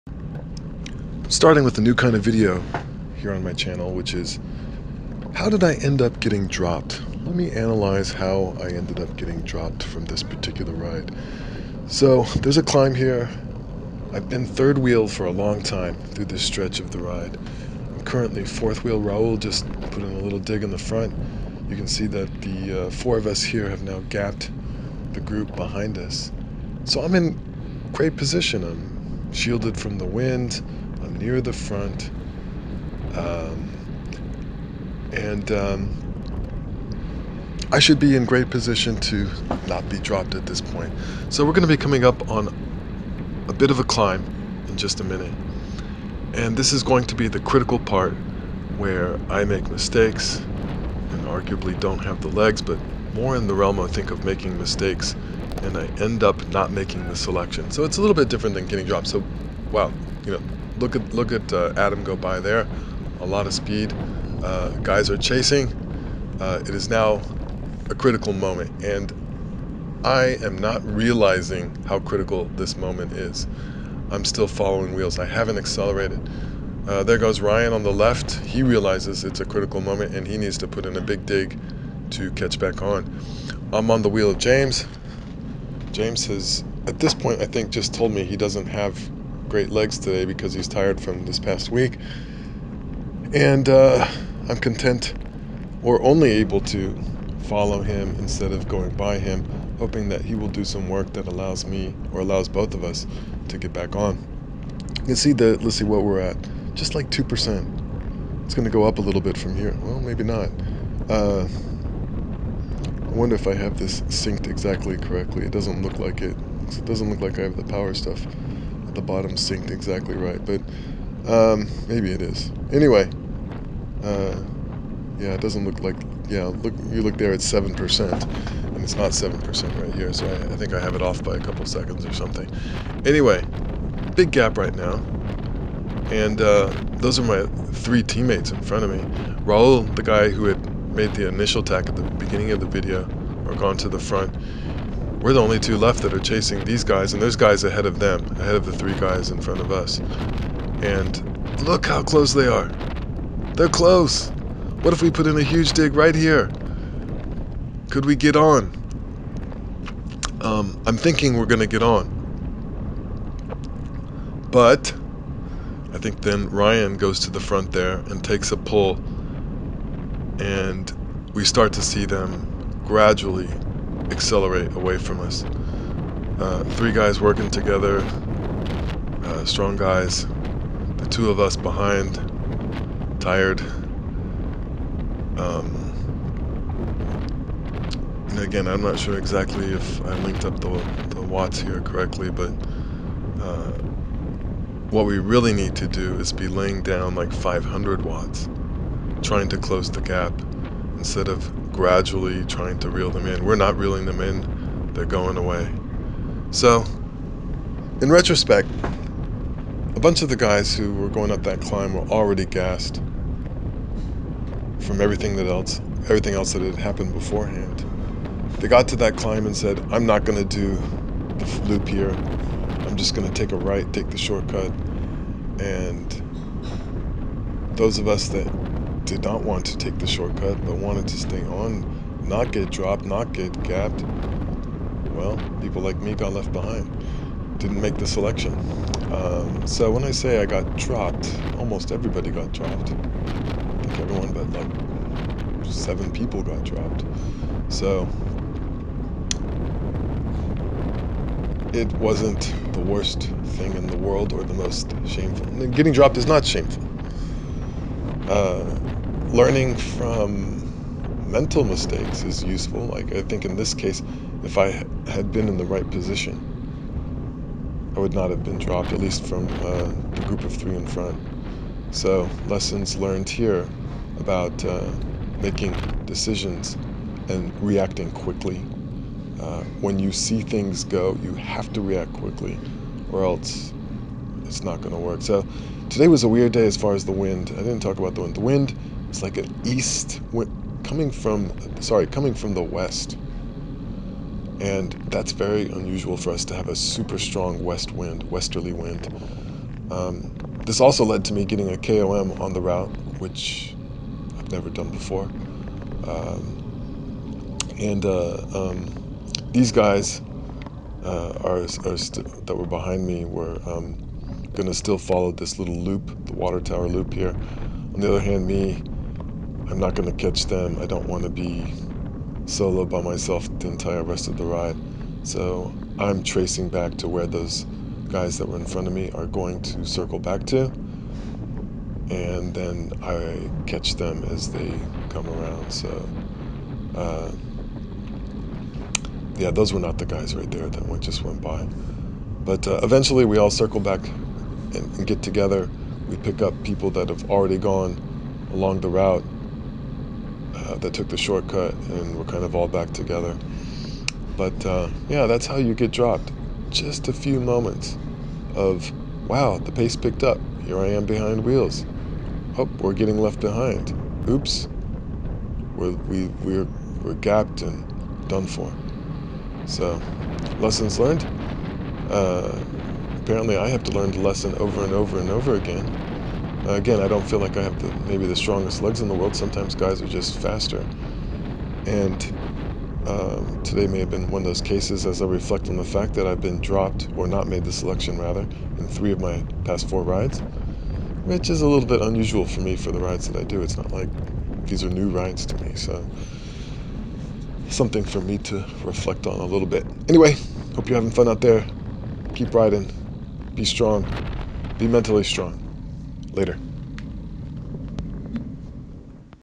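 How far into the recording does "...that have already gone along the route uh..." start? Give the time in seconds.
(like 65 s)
346 s.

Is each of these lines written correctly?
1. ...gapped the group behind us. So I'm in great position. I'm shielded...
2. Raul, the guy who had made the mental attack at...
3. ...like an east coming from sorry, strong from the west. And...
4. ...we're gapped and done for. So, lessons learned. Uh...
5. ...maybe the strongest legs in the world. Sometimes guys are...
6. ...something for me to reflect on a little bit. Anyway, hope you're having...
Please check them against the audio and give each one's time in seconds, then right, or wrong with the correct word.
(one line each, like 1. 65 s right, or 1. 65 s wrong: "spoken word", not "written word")
1. 24 s right
2. 139 s wrong: "initial", not "mental"
3. 289 s wrong: "coming", not "strong"
4. 367 s right
5. 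378 s right
6. 397 s right.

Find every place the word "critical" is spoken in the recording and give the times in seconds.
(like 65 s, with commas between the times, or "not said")
47 s, 67 s, 71 s, 79 s.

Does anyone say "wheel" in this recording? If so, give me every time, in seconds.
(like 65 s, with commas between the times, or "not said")
14 s, 18 s, 74 s, 84 s, 361 s.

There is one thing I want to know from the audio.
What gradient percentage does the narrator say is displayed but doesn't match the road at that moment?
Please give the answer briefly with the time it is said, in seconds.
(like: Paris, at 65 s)
7%, at 127 s.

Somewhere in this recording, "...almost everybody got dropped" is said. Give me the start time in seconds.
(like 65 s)
241 s.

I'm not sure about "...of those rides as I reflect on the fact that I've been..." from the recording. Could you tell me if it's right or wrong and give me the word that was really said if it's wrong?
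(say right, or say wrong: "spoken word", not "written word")
wrong: "cases", not "rides".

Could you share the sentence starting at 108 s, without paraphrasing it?
It's going to go up a little bit from here.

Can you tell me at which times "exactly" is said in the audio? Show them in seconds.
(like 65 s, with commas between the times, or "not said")
114 s, 119 s, 189 s.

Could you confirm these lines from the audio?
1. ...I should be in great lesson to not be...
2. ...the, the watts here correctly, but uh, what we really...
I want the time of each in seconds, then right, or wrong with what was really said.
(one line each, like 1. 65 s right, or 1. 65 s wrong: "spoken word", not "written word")
1. 37 s wrong: "position", not "lesson"
2. 190 s right.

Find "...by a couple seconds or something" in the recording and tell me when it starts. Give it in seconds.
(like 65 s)
131 s.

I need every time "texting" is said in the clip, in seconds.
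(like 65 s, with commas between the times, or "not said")
not said.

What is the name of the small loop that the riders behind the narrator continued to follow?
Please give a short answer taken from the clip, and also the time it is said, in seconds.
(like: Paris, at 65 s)
water tower loop, at 316 s.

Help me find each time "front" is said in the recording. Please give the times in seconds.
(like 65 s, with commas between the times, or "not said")
20 s, 31 s, 138 s, 143 s, 149 s, 167 s, 270 s, 328 s.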